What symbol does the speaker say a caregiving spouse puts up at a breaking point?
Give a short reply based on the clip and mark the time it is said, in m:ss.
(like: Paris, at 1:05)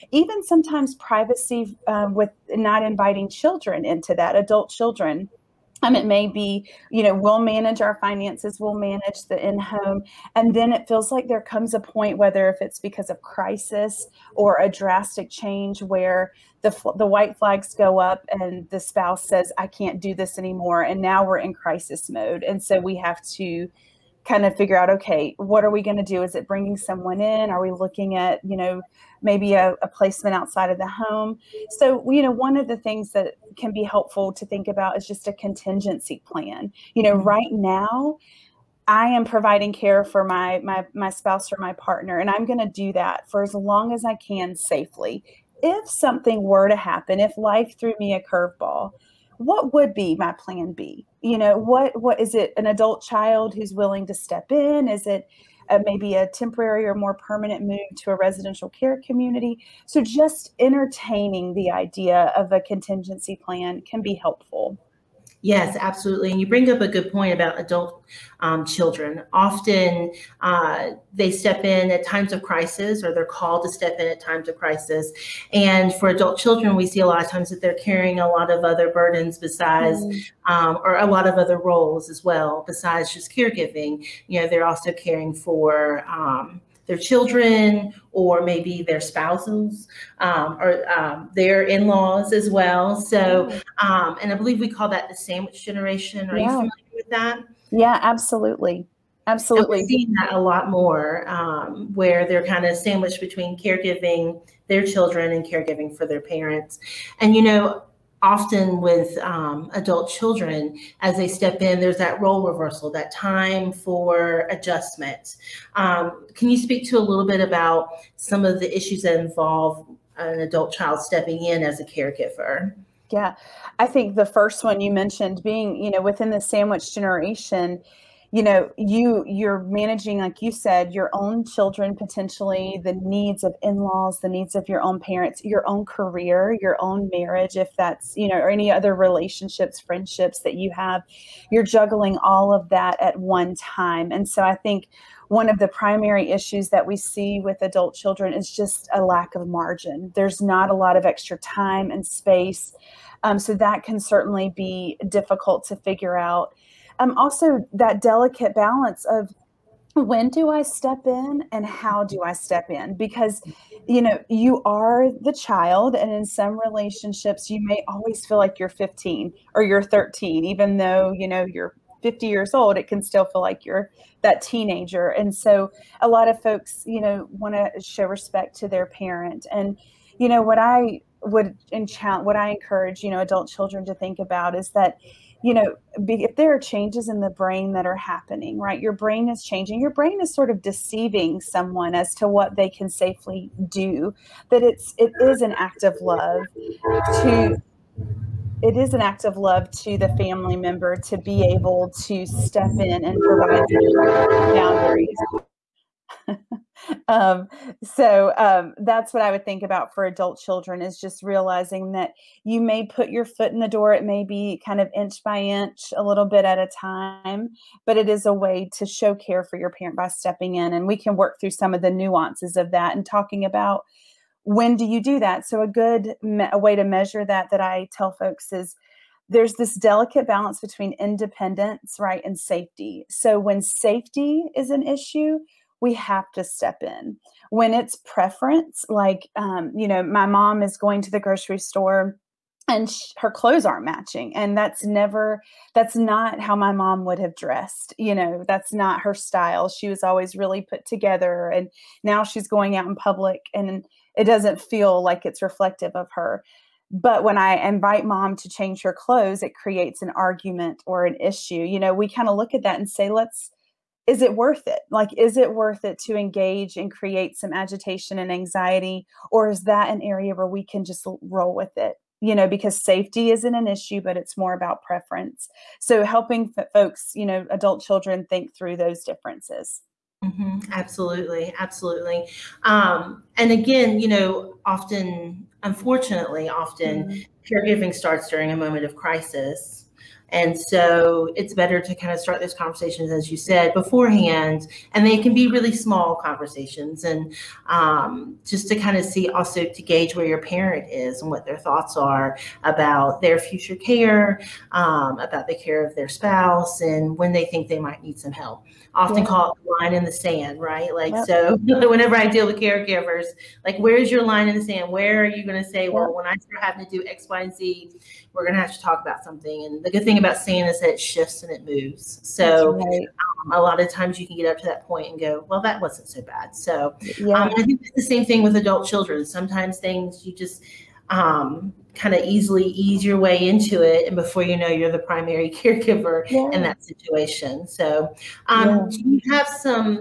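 white flags, at 0:17.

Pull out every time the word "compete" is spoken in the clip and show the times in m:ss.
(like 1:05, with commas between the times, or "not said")
not said.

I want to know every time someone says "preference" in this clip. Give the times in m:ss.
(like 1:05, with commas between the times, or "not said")
3:58, 4:34.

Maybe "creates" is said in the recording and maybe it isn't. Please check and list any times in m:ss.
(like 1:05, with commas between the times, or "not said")
4:19, 4:26.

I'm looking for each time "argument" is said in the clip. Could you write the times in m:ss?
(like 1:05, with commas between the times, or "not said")
4:20.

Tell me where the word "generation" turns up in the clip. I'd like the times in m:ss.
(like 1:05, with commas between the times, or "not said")
1:35, 2:06.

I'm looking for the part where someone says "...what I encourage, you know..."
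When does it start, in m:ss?
3:02.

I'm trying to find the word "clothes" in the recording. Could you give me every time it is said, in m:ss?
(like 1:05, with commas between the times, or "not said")
4:03, 4:18.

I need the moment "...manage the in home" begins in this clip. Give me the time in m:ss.
0:08.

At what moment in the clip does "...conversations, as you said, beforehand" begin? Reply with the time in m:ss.
4:52.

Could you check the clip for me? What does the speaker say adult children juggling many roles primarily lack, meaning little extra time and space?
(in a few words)
margin.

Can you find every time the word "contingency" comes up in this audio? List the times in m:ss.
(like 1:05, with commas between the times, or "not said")
0:35, 1:02.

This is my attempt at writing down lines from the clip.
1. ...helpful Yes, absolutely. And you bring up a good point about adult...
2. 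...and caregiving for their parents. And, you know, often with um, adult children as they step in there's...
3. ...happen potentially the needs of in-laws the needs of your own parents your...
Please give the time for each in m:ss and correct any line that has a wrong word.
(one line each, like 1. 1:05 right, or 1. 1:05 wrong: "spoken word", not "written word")
1. 1:04 right
2. 1:45 right
3. 2:11 wrong: "children", not "happen".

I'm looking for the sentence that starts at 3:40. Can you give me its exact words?
And we can work through some of the nuances of that and talking about when do you do that.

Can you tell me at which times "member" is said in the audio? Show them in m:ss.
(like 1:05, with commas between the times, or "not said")
3:20.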